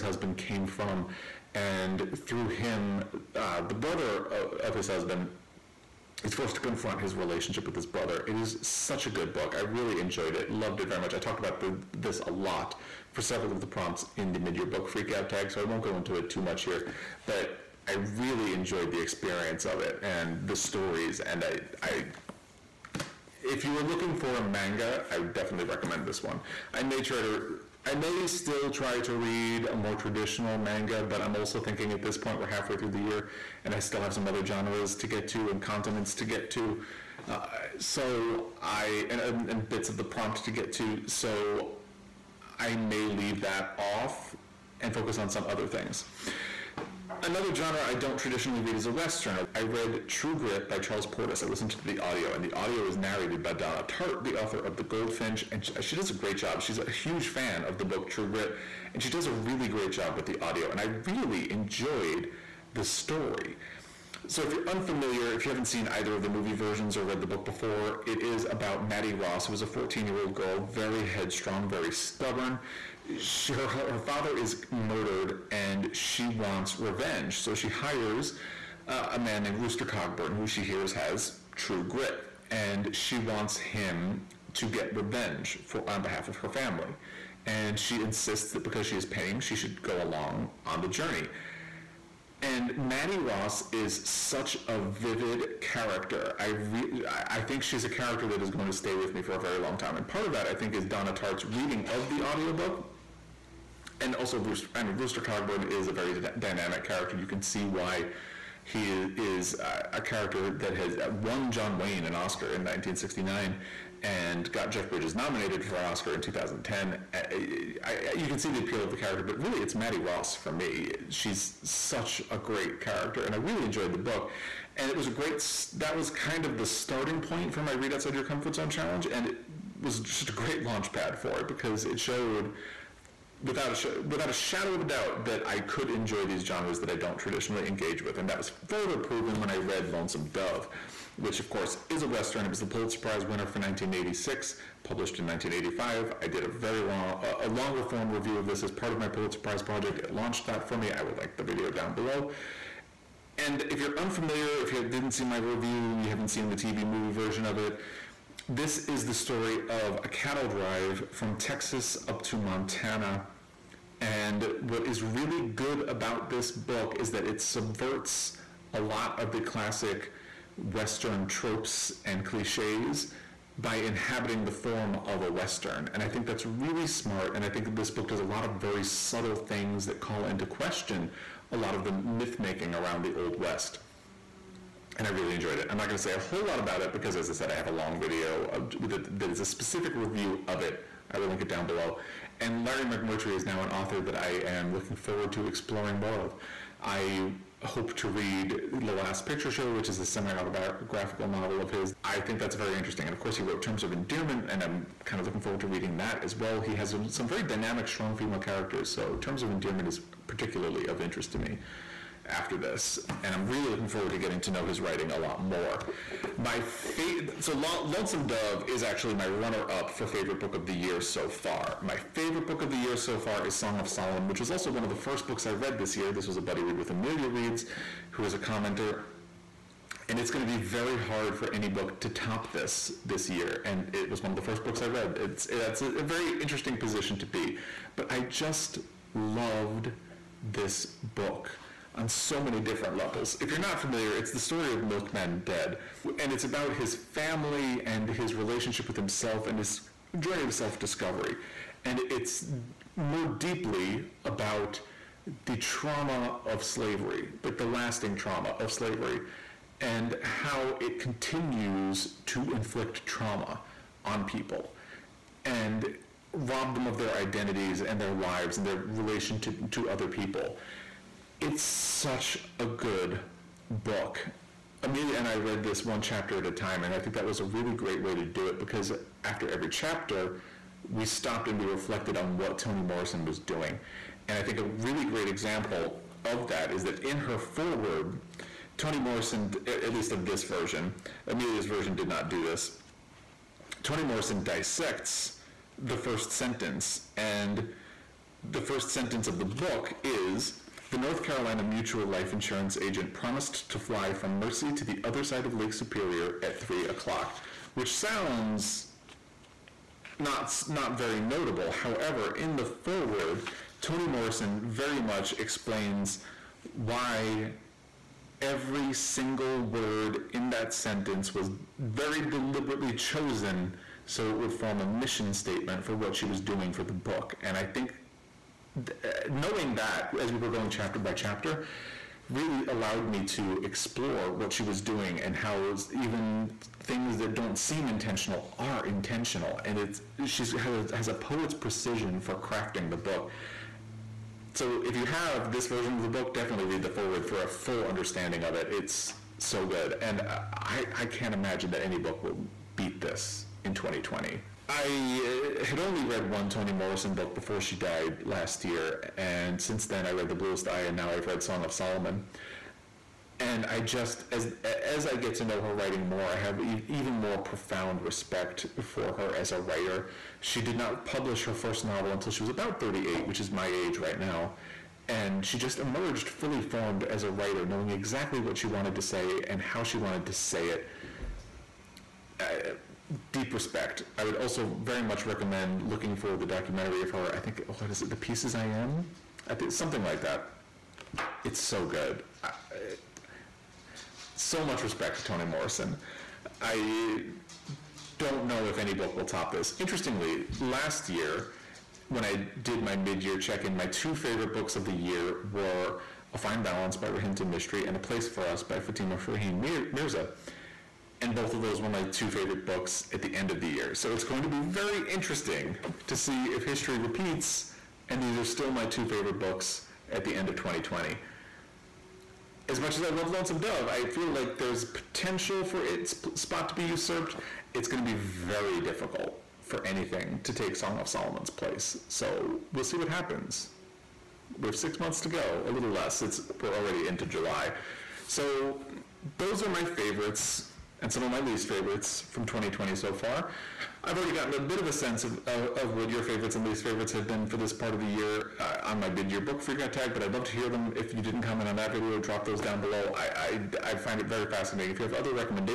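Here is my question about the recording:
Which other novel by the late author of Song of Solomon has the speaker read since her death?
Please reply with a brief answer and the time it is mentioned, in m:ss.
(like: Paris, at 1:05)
The Bluest Eye, at 6:00.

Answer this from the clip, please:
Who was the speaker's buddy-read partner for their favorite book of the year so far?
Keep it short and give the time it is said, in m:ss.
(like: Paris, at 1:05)
Amelia Reads, at 3:46.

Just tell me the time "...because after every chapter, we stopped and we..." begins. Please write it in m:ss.
4:38.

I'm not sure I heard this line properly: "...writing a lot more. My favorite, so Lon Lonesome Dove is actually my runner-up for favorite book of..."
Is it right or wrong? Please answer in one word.
right.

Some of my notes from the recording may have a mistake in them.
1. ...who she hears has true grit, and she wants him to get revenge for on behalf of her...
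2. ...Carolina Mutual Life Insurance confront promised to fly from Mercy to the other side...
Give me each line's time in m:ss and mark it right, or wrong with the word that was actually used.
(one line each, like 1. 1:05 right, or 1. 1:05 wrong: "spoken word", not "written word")
1. 1:20 right
2. 5:01 wrong: "agent", not "confront".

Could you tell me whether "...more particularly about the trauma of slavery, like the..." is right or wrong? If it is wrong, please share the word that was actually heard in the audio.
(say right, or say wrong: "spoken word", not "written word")
wrong: "deeply", not "particularly".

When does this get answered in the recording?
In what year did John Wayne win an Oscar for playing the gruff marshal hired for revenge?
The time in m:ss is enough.
1:52.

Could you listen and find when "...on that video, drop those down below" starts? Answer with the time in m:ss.
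7:31.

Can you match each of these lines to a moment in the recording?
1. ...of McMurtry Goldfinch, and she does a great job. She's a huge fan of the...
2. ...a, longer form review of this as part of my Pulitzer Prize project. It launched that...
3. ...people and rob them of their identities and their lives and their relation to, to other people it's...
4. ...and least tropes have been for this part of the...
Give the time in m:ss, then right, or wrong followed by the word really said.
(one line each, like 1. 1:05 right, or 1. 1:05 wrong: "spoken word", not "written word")
1. 0:54 wrong: "The", not "McMurtry"
2. 2:27 right
3. 4:24 right
4. 7:26 wrong: "favorites", not "tropes".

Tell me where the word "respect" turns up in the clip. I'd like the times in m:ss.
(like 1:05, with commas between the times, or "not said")
6:08, 6:23, 6:34.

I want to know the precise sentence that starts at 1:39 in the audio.
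And part of that I think is Donna Tartt's reading of the audiobook and also Rooster.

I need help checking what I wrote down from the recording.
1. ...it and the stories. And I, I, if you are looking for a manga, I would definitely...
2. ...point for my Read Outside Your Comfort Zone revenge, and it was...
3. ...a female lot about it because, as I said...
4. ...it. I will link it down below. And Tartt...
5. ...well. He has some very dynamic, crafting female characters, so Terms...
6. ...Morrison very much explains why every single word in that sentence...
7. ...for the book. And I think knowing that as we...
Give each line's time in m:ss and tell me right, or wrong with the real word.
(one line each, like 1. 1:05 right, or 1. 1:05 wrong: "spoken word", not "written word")
1. 0:19 right
2. 2:07 wrong: "challenge", not "revenge"
3. 3:06 wrong: "whole", not "female"
4. 3:10 wrong: "Larry", not "Tartt"
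5. 3:26 wrong: "strong", not "crafting"
6. 5:14 right
7. 5:26 right.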